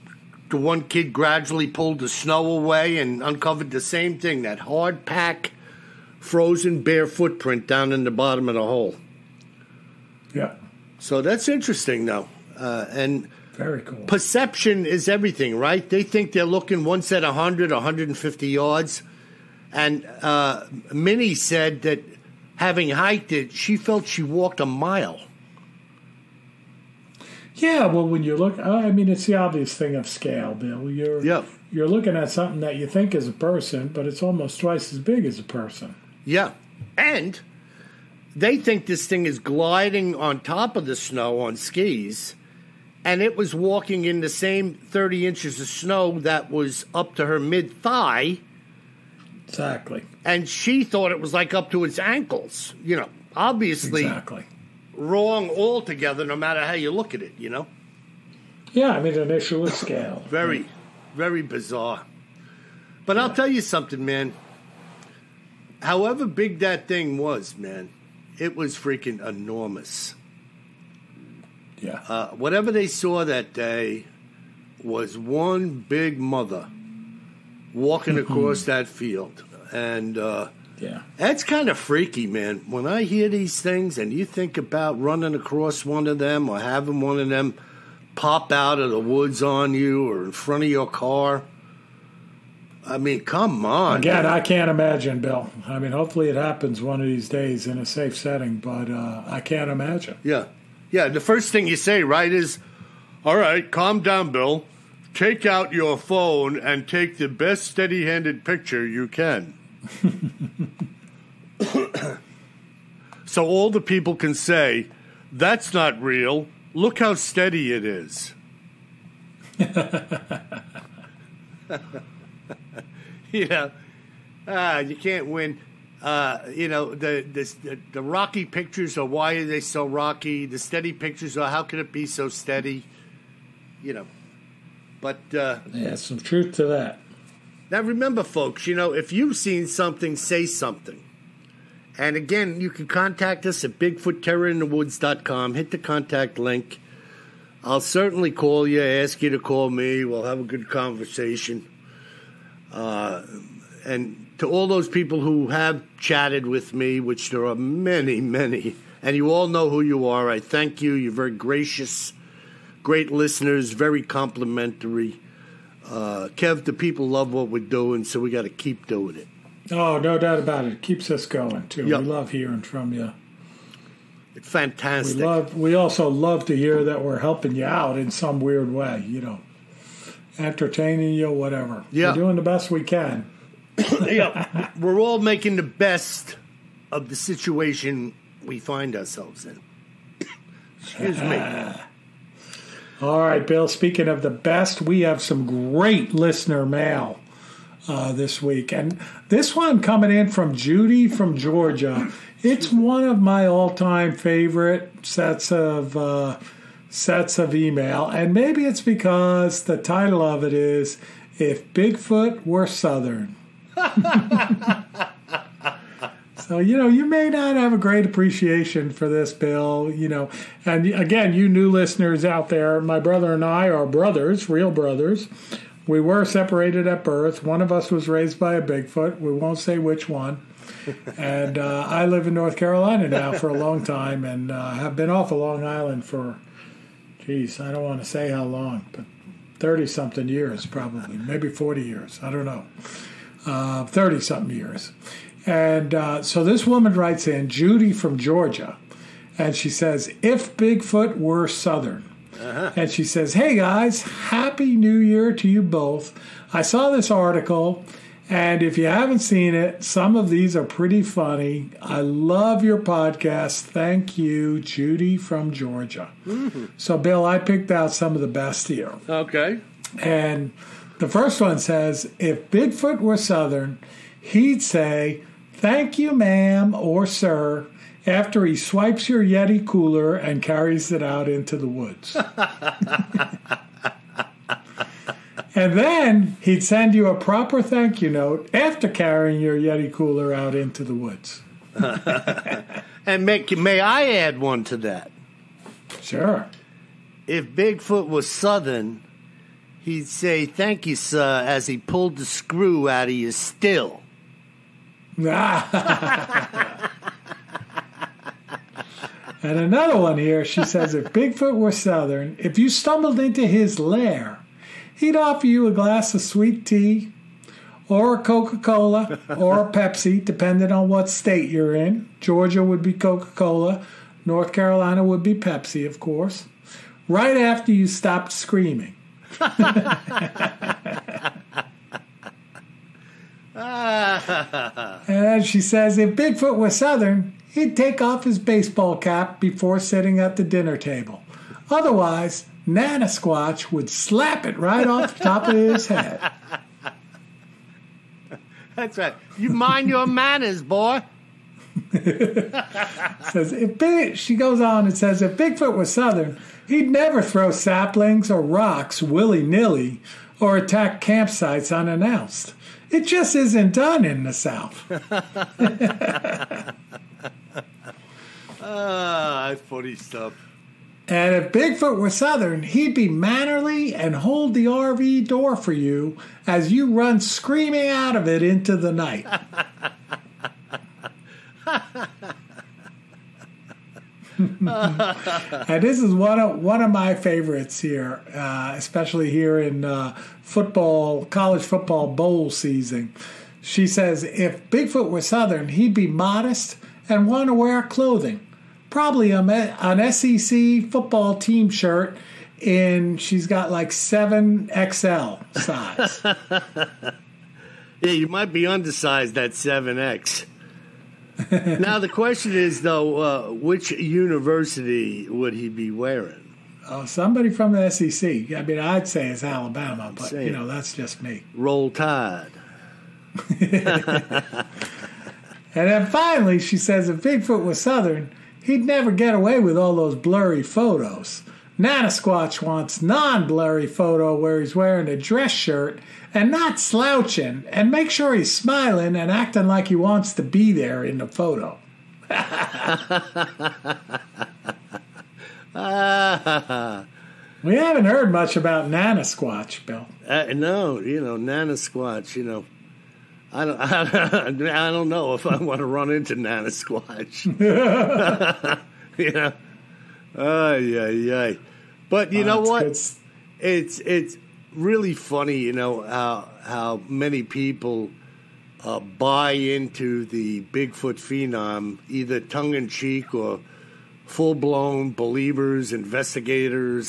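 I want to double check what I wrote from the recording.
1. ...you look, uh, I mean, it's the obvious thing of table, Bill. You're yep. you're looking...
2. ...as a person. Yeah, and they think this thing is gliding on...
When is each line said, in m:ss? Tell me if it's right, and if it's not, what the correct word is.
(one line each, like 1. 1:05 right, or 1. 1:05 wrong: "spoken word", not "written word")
1. 0:28 wrong: "scale", not "table"
2. 0:35 right.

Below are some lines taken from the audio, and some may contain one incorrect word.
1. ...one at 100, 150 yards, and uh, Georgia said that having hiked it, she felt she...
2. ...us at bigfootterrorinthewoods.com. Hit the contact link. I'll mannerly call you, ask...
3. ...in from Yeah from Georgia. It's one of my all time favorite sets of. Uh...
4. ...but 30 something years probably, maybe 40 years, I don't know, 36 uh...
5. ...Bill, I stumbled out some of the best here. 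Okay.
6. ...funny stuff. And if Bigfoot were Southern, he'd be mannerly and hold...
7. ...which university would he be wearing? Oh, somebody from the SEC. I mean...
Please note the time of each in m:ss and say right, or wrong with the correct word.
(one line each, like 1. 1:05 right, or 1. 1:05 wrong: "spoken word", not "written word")
1. 0:16 wrong: "Minnie", not "Georgia"
2. 2:23 wrong: "certainly", not "mannerly"
3. 3:20 wrong: "Judy", not "Yeah"
4. 3:58 wrong: "30", not "36"
5. 4:26 wrong: "picked", not "stumbled"
6. 6:09 right
7. 6:53 right.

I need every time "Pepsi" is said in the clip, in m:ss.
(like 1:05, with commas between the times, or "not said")
5:19, 5:25.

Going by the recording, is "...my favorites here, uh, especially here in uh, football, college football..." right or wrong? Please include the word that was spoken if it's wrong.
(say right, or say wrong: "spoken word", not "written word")
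right.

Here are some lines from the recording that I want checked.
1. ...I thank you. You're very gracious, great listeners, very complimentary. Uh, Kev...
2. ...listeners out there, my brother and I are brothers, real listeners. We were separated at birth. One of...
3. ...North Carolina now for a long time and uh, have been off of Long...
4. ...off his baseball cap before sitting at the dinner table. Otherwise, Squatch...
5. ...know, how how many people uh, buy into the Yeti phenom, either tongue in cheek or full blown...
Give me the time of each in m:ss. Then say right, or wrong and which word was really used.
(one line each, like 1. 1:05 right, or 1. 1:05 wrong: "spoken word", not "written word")
1. 2:40 right
2. 3:41 wrong: "brothers", not "listeners"
3. 3:52 right
4. 5:38 right
5. 7:45 wrong: "Bigfoot", not "Yeti".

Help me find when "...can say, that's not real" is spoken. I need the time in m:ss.
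1:54.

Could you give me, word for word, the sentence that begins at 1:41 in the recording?
The first thing you say, right, is, all right, calm down, Bill.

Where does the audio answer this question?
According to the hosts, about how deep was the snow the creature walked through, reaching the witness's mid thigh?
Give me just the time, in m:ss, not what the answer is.
0:44.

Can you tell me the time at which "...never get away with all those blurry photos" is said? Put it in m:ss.
7:08.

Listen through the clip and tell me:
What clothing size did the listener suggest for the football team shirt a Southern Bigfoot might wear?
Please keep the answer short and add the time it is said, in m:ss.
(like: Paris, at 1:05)
7XL, at 6:43.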